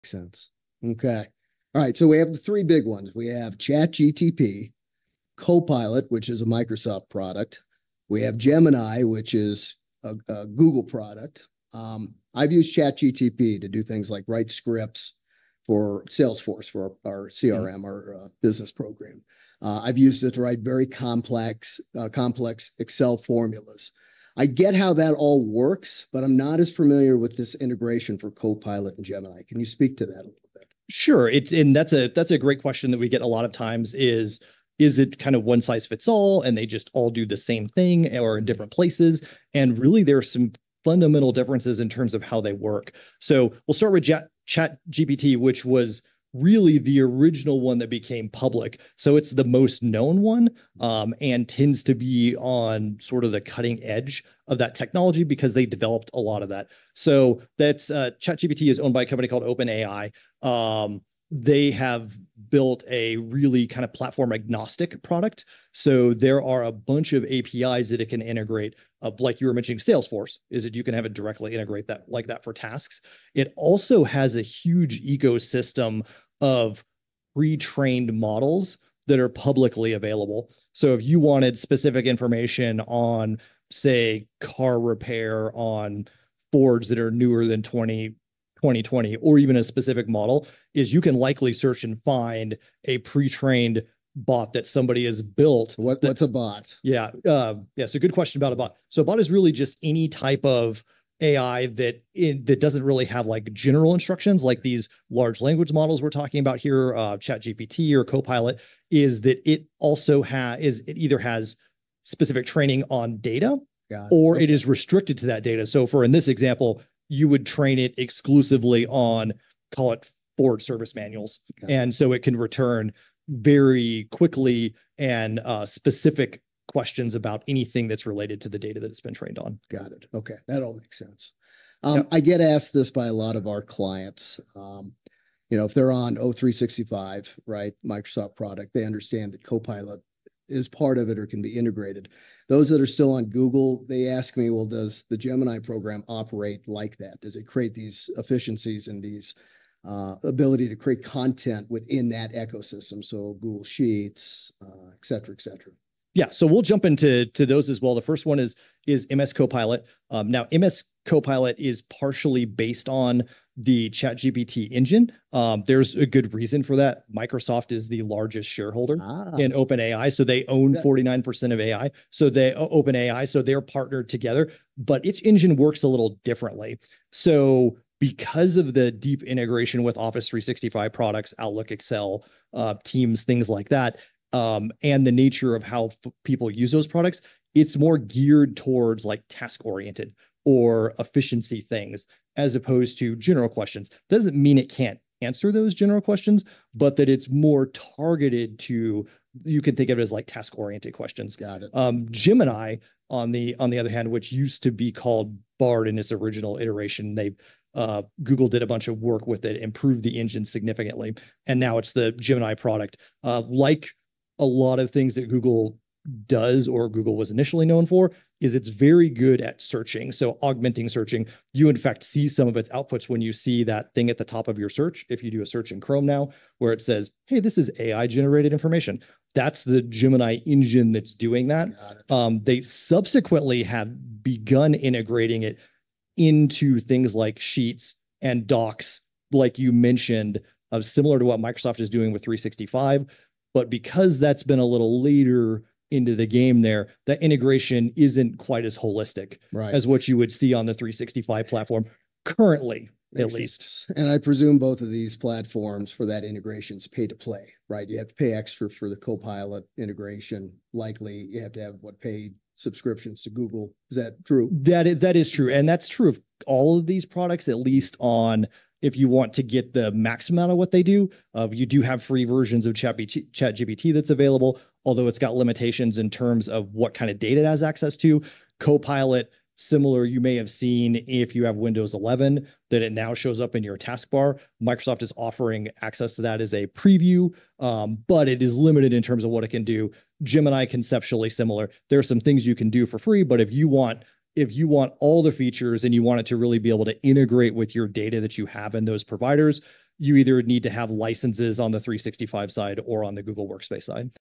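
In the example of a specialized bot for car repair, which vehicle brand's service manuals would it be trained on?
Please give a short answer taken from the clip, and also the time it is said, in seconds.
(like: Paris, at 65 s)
Ford, at 120 s.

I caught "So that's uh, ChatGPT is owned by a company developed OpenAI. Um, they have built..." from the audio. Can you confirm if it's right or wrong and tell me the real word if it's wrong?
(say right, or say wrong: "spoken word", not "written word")
wrong: "called", not "developed".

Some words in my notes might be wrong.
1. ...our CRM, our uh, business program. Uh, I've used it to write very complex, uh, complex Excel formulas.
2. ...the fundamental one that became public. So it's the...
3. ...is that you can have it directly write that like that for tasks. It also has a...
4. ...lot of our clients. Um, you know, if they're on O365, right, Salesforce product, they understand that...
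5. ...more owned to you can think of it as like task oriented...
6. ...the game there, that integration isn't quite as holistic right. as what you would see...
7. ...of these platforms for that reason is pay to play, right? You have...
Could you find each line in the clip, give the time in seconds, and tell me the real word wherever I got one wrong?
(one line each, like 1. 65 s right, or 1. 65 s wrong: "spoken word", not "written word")
1. 17 s right
2. 46 s wrong: "original", not "fundamental"
3. 70 s wrong: "integrate", not "write"
4. 133 s wrong: "Microsoft", not "Salesforce"
5. 197 s wrong: "targeted", not "owned"
6. 246 s right
7. 254 s wrong: "integration", not "reason".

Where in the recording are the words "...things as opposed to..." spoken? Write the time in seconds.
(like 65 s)
191 s.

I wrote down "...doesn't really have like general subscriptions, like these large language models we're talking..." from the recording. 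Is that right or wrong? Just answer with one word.
wrong.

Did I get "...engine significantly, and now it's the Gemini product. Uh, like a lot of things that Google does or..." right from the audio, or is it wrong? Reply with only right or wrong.
right.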